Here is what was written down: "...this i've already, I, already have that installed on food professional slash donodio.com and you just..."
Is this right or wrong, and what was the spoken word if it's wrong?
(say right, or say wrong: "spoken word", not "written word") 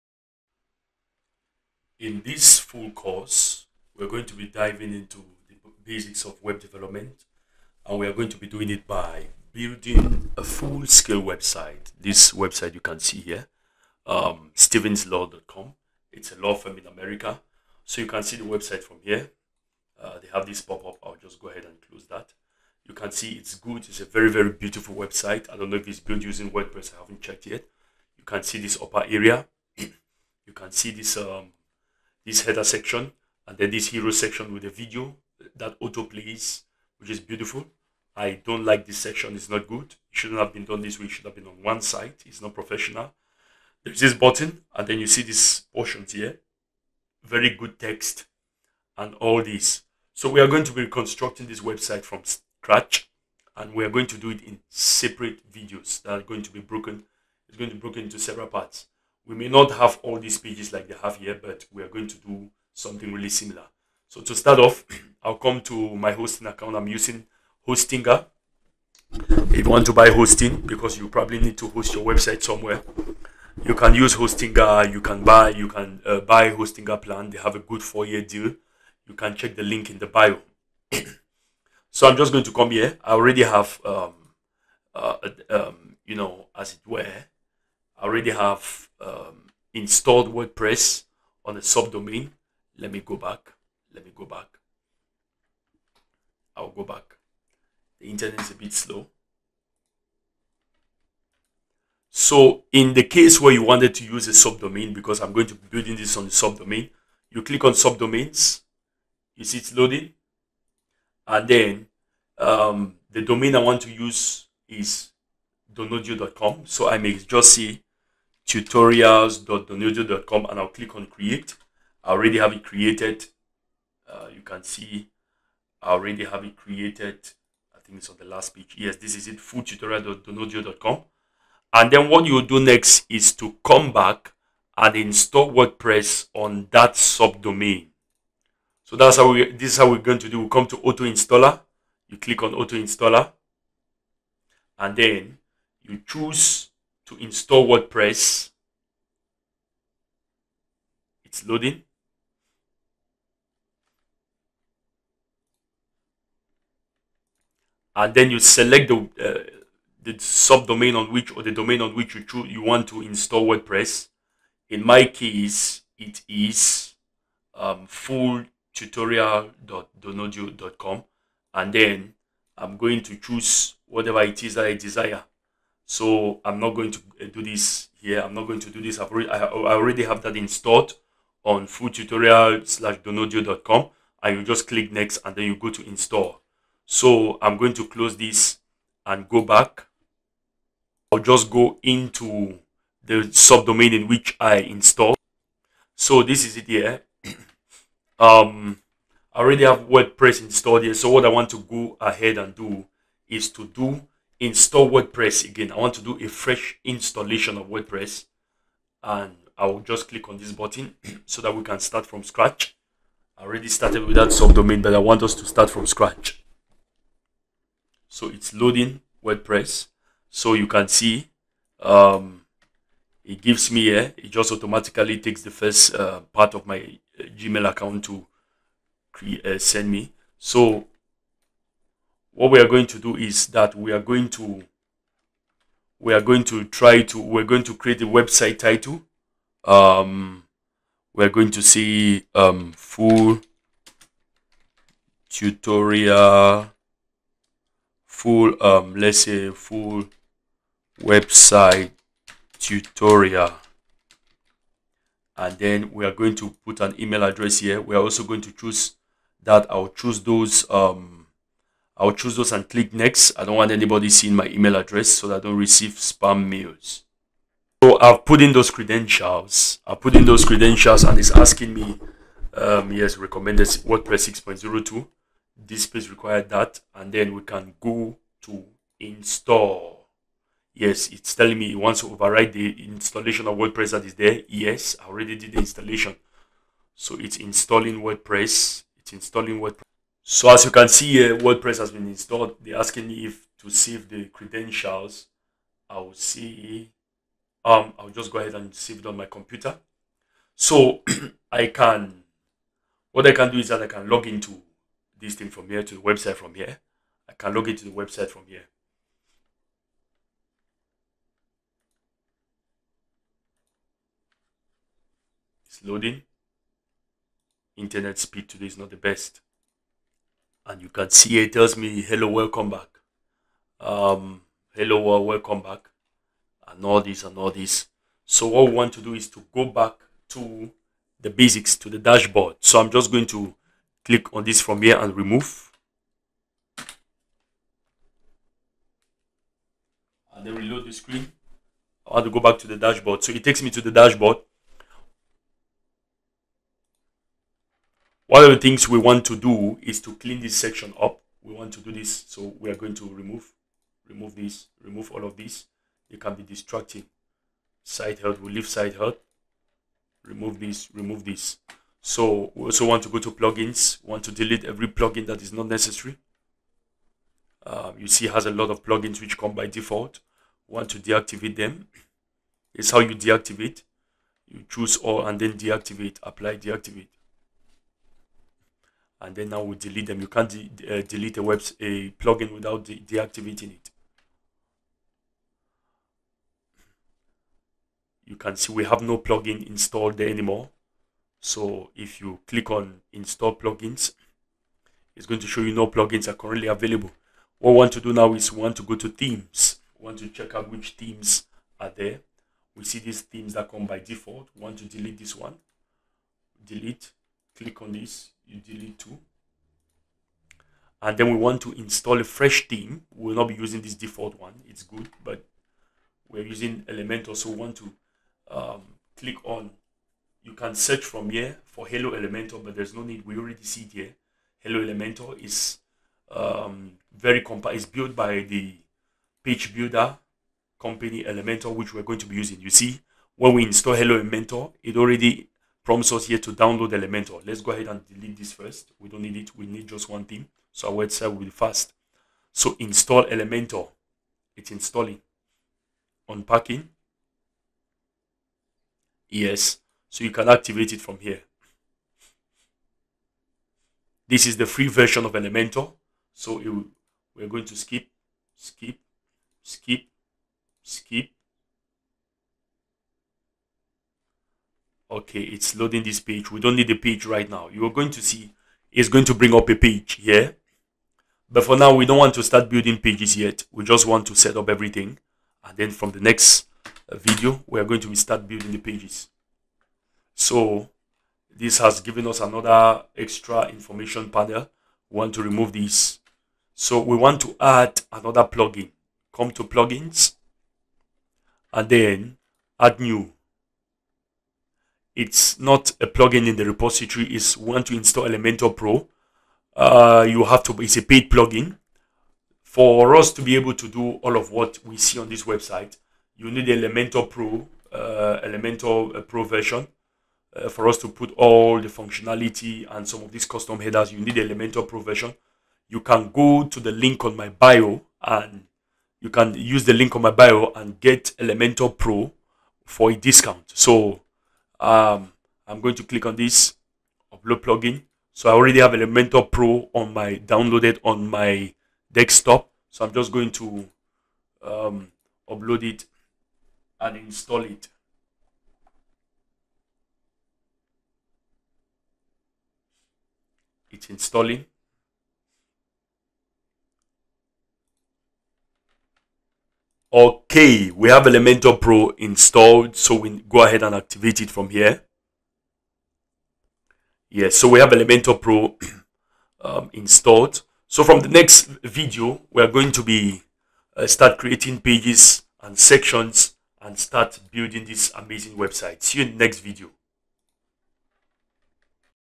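wrong: "tutorial", not "professional".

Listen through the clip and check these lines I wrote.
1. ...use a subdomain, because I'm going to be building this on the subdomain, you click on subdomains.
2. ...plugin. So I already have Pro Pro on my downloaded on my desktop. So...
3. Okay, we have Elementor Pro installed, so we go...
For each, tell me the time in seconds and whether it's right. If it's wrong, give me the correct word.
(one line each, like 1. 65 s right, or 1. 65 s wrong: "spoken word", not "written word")
1. 104 s right
2. 527 s wrong: "Elementor", not "Pro"
3. 550 s right.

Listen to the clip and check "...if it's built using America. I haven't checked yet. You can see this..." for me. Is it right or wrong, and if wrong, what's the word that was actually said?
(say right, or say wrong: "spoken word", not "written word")
wrong: "WordPress", not "America".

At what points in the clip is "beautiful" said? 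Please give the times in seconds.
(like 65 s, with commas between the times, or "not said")
24 s, 37 s.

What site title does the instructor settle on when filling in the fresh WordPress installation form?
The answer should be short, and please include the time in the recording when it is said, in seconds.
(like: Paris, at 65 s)
full website tutorial, at 249 s.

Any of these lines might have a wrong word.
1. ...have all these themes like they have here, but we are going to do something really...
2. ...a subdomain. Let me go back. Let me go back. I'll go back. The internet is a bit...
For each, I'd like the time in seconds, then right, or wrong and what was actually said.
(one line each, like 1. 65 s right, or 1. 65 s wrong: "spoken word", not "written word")
1. 59 s wrong: "pages", not "themes"
2. 91 s right.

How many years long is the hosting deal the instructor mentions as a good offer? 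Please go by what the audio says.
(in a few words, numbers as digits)
4.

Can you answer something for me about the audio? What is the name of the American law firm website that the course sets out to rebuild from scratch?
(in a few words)
stevenslaw.com.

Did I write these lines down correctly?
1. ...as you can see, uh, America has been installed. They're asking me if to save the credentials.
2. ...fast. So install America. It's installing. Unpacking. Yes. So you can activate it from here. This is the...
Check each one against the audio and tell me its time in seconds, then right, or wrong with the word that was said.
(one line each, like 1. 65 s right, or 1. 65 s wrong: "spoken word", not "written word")
1. 290 s wrong: "WordPress", not "America"
2. 441 s wrong: "Elementor", not "America".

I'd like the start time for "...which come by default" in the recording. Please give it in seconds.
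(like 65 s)
369 s.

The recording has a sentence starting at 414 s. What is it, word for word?
It's good, but we're using Elementor.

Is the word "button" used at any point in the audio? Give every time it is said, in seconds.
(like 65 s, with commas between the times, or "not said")
44 s, 210 s.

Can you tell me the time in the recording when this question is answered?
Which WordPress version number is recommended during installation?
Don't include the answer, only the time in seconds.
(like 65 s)
274 s.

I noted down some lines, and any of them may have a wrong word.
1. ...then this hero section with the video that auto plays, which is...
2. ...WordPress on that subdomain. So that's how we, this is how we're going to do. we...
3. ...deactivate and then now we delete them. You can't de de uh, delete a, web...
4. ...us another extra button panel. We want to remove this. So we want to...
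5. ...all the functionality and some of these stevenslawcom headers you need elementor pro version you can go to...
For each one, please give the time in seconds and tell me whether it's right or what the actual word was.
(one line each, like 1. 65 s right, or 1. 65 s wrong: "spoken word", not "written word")
1. 33 s right
2. 135 s right
3. 376 s right
4. 482 s wrong: "information", not "button"
5. 511 s wrong: "custom", not "stevenslawcom".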